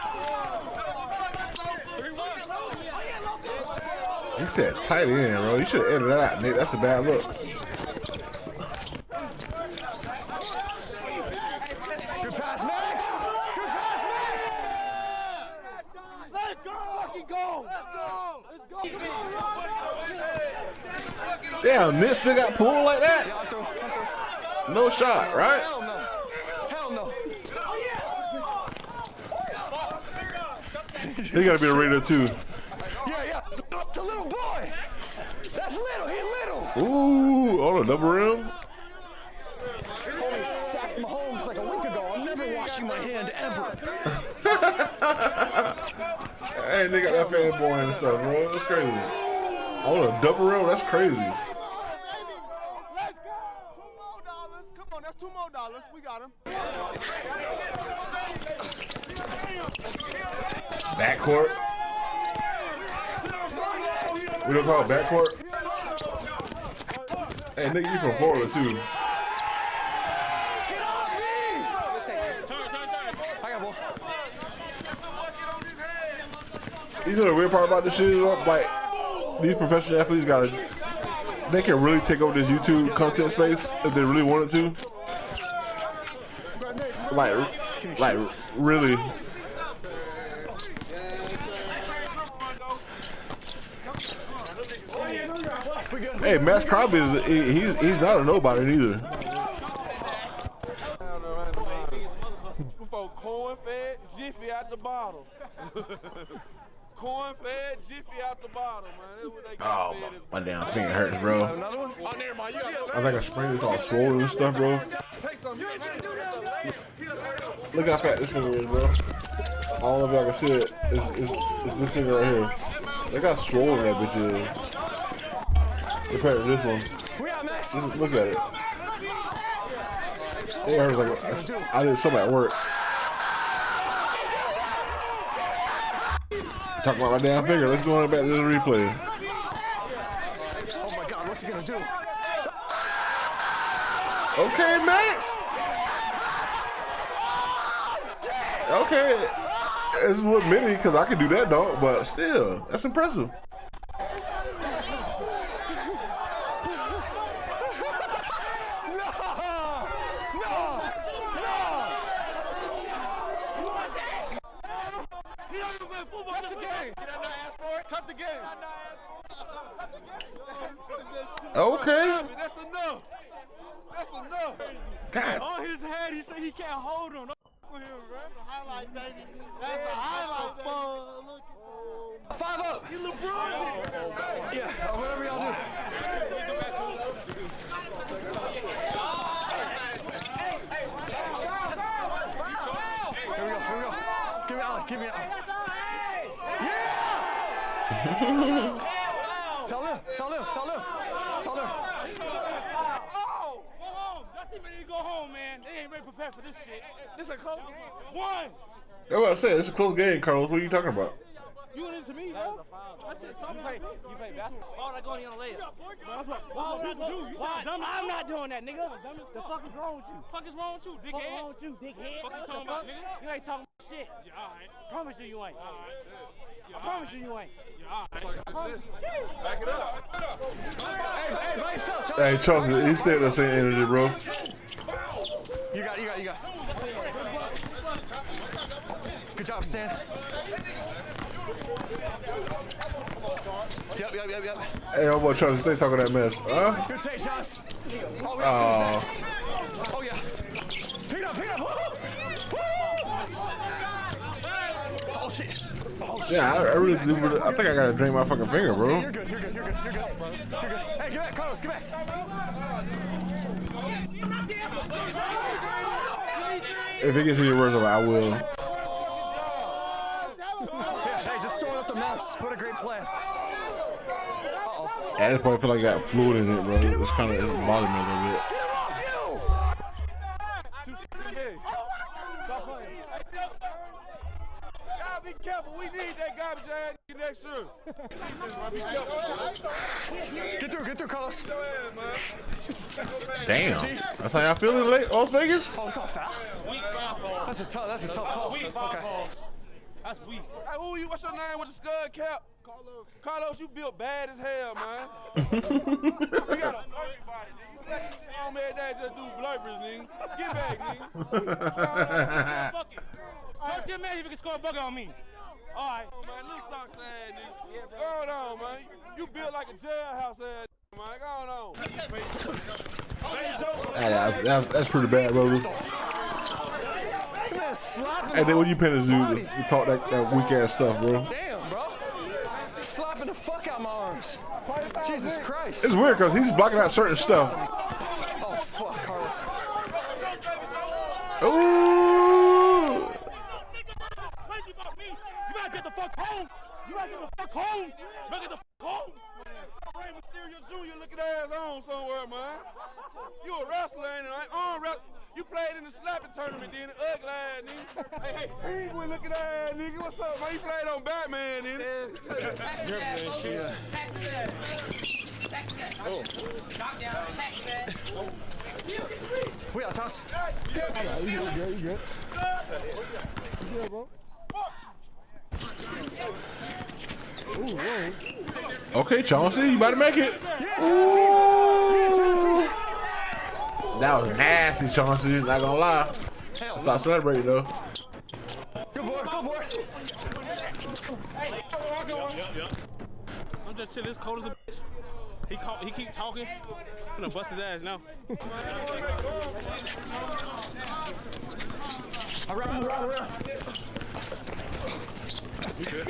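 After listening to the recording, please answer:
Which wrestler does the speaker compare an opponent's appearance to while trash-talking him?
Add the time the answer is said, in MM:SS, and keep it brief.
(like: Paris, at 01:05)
Rey Mysterio Jr., at 05:50.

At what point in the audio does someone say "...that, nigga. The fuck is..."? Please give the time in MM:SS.
03:38.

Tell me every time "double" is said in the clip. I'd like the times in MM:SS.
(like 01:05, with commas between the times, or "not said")
00:37, 00:50.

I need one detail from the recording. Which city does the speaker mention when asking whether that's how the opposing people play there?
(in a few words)
Las Vegas.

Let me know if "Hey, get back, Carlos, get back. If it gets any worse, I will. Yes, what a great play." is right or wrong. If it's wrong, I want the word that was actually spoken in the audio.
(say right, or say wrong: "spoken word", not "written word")
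right.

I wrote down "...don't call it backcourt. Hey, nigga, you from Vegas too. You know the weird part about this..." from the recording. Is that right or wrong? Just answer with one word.
wrong.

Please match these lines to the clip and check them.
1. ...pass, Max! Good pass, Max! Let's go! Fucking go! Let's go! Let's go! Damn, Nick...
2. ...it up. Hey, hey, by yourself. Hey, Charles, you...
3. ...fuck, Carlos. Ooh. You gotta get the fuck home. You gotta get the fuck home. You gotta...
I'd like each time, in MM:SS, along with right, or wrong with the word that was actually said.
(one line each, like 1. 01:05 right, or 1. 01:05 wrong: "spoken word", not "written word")
1. 00:12 right
2. 03:49 right
3. 05:38 right.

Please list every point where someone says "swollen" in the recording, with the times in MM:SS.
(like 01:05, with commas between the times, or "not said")
01:53, 02:03.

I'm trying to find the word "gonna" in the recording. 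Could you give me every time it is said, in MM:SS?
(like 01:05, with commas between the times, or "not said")
02:21, 04:05, 06:25, 06:37.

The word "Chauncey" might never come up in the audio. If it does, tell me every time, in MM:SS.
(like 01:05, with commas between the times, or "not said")
06:19, 06:24.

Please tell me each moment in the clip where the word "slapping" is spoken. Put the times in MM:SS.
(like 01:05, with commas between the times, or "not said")
05:32, 05:55.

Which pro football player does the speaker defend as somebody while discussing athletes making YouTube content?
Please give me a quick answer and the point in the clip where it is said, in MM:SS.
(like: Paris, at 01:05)
Maxx Crosby, at 01:36.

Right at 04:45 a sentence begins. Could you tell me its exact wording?
Be careful, we need that garbage I had next year.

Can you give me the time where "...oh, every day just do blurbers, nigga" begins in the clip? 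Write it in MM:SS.
05:08.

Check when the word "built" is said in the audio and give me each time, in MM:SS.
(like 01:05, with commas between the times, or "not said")
05:03, 05:19.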